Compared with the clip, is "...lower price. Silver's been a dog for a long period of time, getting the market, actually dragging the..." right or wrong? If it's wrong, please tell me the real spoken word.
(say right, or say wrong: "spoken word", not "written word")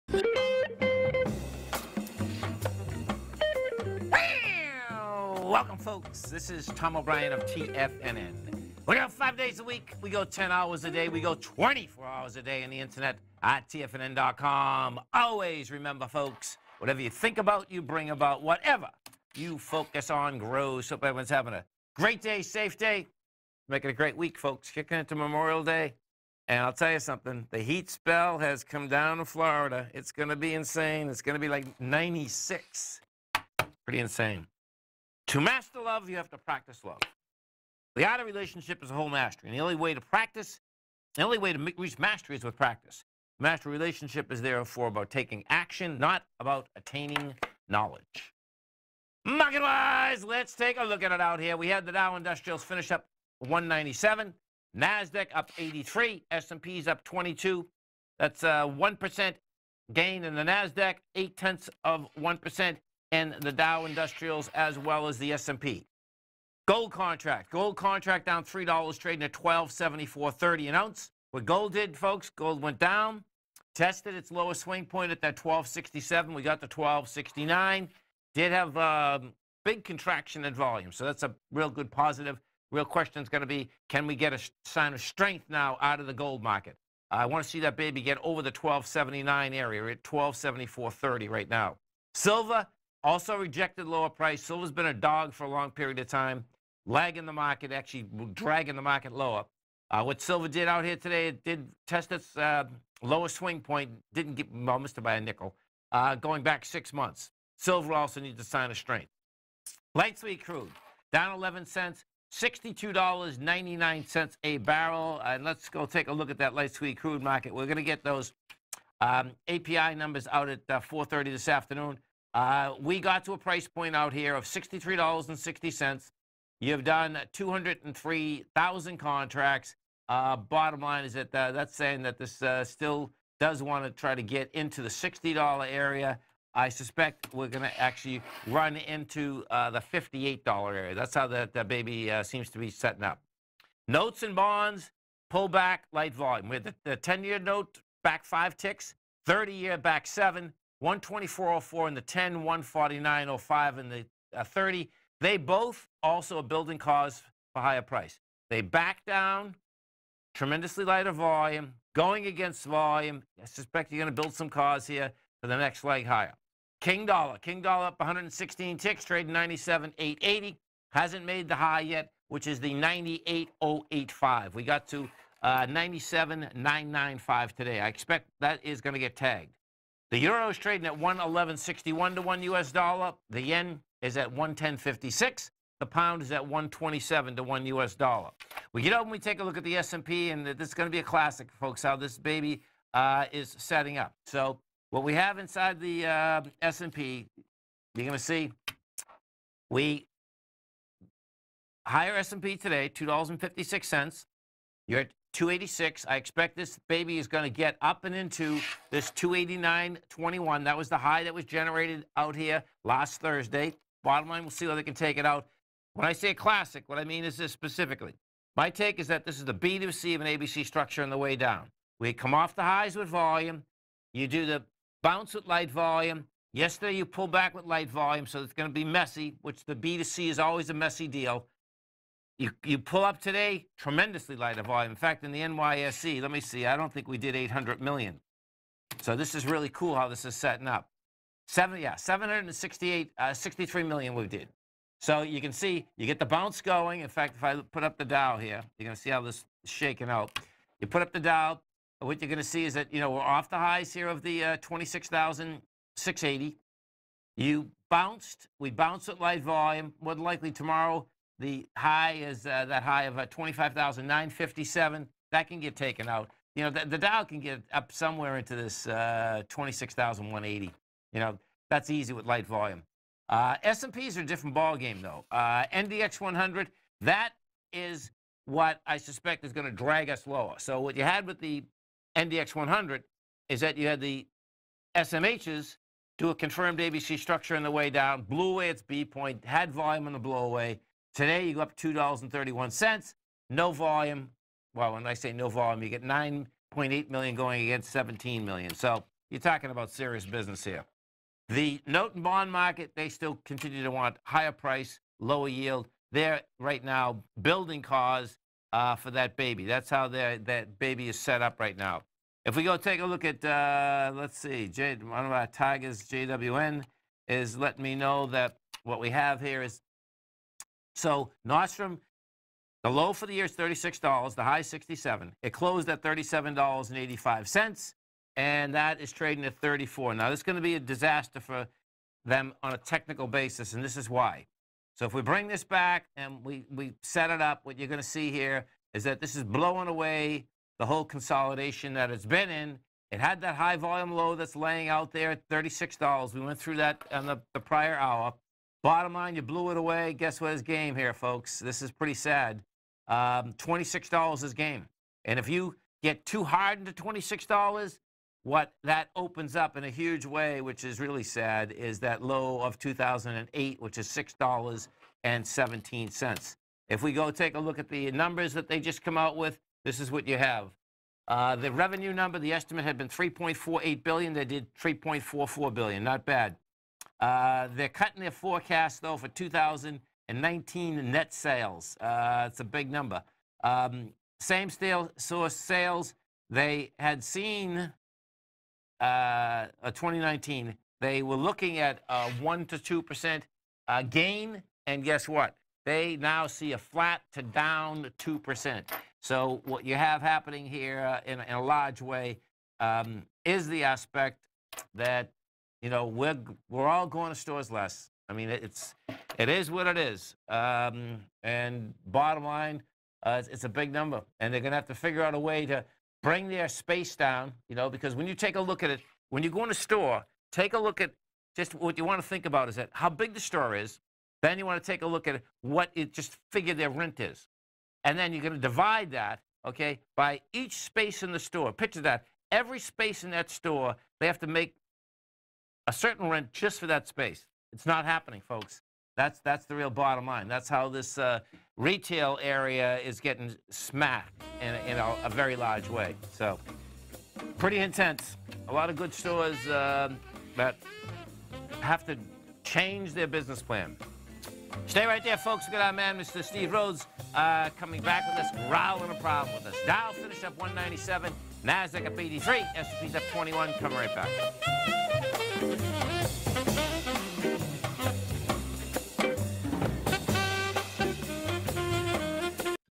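wrong: "lagging", not "getting".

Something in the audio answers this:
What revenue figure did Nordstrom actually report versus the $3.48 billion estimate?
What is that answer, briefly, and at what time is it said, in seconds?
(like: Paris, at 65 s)
3.44 billion, at 374 s.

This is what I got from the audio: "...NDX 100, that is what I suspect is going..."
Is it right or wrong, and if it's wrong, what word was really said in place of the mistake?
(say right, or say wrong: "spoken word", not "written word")
right.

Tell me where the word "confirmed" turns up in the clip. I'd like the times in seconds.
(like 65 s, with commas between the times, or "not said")
286 s.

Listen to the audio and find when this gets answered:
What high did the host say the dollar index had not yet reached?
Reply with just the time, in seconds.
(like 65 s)
172 s.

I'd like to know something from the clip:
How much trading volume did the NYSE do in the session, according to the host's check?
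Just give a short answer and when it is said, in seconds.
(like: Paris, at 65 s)
768 million, at 241 s.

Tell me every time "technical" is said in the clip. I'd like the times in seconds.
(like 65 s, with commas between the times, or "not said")
332 s.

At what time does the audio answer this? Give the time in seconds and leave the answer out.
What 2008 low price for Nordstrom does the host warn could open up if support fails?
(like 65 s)
364 s.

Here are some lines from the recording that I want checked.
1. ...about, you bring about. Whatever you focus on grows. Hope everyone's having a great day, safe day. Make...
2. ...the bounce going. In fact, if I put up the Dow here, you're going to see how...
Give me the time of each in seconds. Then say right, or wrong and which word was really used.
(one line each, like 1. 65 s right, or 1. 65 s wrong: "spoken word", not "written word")
1. 17 s right
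2. 246 s right.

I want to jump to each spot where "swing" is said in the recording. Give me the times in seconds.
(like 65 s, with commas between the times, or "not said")
74 s, 103 s.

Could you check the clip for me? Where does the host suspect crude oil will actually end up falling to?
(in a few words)
$58.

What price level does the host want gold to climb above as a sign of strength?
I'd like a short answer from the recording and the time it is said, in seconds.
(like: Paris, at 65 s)
1279, at 88 s.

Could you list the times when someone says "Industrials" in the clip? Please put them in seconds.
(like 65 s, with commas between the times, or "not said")
52 s, 63 s.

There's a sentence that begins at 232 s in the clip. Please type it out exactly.
You, you pull up today, tremendously light of volume.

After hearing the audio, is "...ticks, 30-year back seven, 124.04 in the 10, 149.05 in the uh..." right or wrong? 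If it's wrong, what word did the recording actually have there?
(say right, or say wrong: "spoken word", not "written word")
right.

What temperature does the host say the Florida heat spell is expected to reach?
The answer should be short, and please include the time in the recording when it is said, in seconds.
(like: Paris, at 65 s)
96, at 31 s.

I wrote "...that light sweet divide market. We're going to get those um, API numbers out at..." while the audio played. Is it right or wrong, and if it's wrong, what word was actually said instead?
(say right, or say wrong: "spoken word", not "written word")
wrong: "crude", not "divide".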